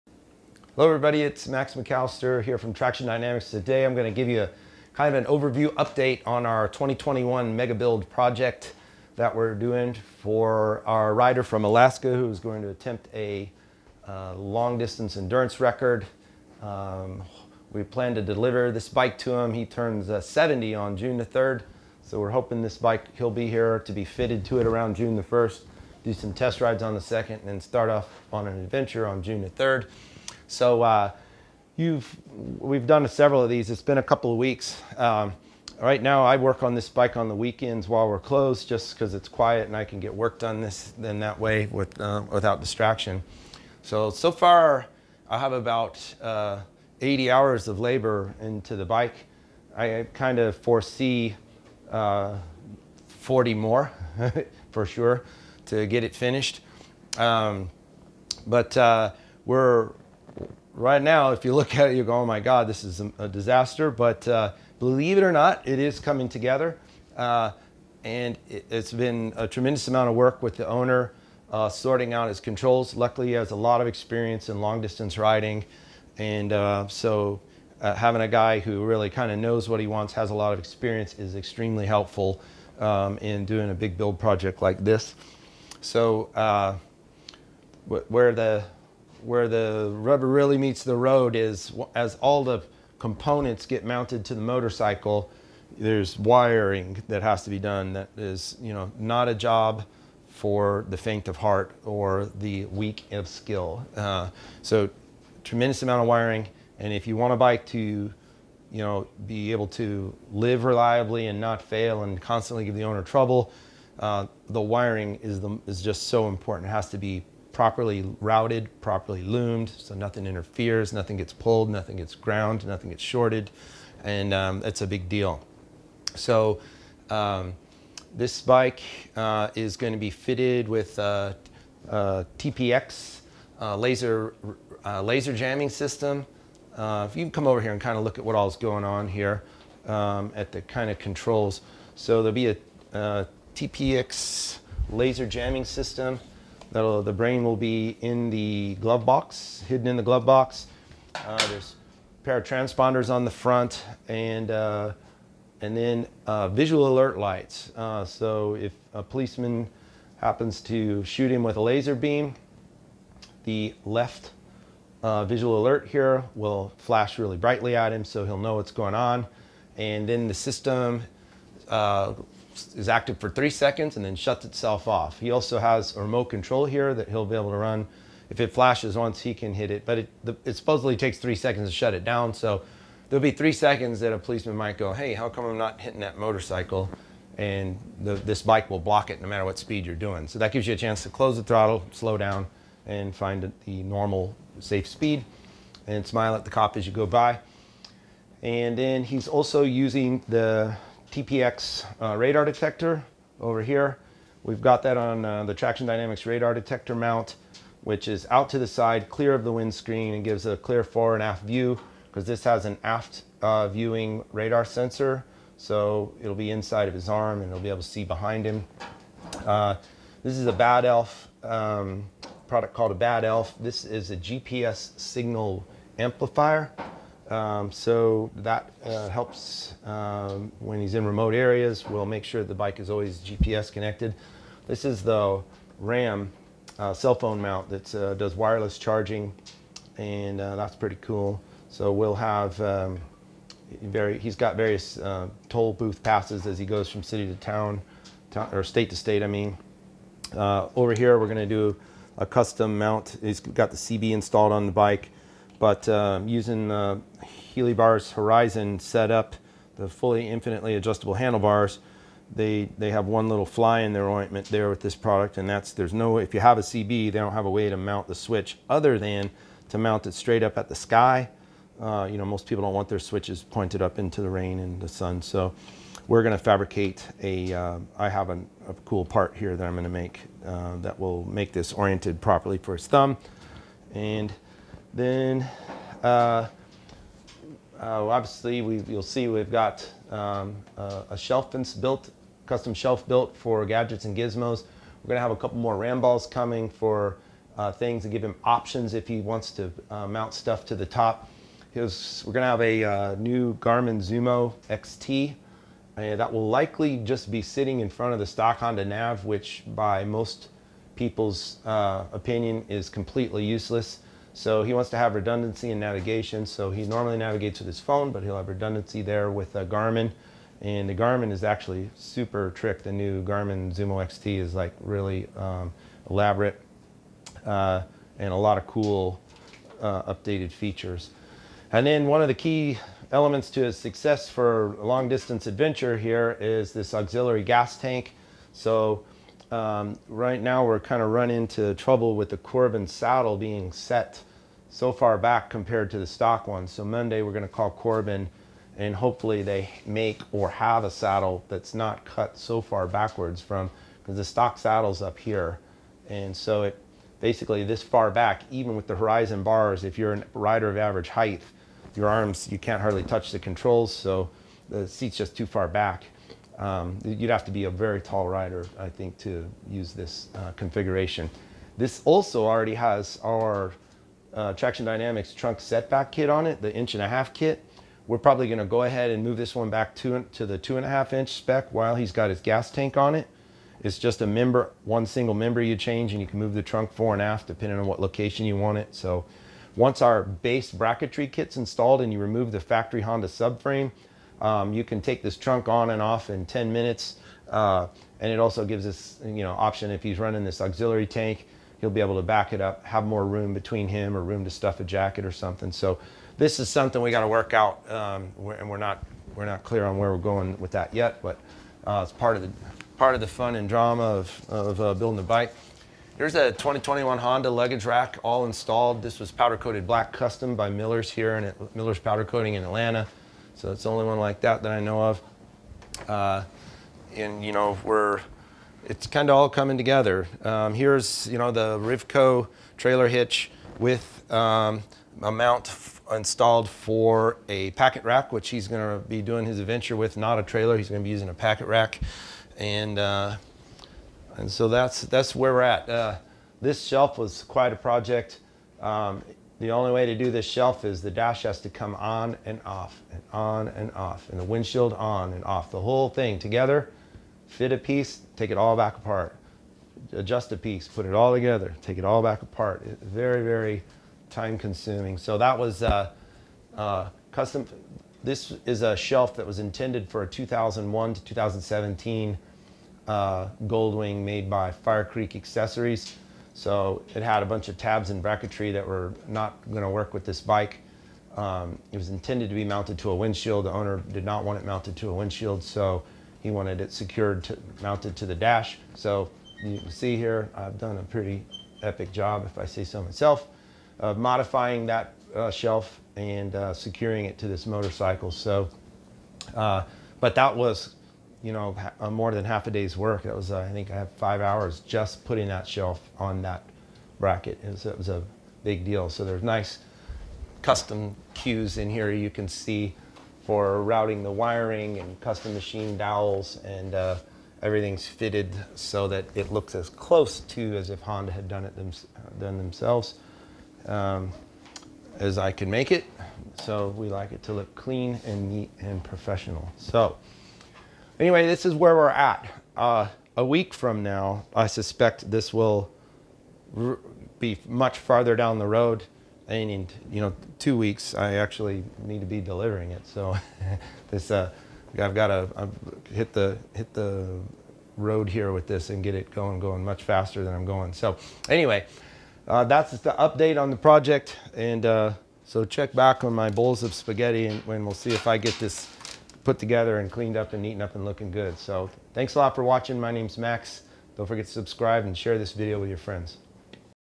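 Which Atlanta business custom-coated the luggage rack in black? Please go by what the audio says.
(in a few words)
Miller's Powder Coating.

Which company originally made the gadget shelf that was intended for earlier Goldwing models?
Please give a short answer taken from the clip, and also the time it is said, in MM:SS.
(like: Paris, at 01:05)
Fire Creek Accessories, at 07:54.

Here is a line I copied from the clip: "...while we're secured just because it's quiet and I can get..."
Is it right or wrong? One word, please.
wrong.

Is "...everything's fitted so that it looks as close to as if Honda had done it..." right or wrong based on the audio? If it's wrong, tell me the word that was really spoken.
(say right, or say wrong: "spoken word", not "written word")
right.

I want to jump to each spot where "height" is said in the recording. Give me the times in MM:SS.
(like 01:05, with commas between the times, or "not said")
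06:01.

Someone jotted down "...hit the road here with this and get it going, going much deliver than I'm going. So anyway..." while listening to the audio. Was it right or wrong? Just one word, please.
wrong.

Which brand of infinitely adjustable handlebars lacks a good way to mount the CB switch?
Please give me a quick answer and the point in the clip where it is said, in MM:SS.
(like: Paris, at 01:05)
HeliBars, at 04:17.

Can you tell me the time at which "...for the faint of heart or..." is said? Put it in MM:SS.
01:40.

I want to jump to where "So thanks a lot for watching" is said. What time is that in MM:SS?
09:21.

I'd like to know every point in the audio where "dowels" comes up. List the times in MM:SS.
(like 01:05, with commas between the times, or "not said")
08:35.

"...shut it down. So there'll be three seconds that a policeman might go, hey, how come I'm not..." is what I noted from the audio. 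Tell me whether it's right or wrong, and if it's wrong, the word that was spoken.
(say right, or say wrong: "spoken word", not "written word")
right.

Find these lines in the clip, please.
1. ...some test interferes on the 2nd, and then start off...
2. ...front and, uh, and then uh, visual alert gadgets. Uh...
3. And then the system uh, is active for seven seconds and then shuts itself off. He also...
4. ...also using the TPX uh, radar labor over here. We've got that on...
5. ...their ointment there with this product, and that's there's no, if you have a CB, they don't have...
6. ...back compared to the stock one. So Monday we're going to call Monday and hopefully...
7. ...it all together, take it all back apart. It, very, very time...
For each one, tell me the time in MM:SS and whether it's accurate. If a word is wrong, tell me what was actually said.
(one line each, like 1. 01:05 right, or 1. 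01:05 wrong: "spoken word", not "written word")
1. 00:26 wrong: "rides", not "interferes"
2. 02:33 wrong: "lights", not "gadgets"
3. 02:49 wrong: "three", not "seven"
4. 03:19 wrong: "detector", not "labor"
5. 04:23 right
6. 05:45 wrong: "Corbin", not "Monday"
7. 07:41 right.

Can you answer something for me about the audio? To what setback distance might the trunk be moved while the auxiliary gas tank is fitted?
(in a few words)
2.5 inches.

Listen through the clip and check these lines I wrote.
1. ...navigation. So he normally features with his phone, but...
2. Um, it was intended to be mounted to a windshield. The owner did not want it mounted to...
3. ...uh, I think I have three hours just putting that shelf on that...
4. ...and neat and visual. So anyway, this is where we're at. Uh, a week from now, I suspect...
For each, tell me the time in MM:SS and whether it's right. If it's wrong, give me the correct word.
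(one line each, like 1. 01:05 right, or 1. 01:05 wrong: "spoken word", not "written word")
1. 05:15 wrong: "navigates", not "features"
2. 08:01 right
3. 08:23 wrong: "five", not "three"
4. 08:48 wrong: "professional", not "visual".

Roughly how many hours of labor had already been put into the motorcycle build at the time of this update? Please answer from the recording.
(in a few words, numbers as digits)
80.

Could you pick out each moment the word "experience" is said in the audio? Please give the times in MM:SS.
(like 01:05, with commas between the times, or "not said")
01:13, 01:20.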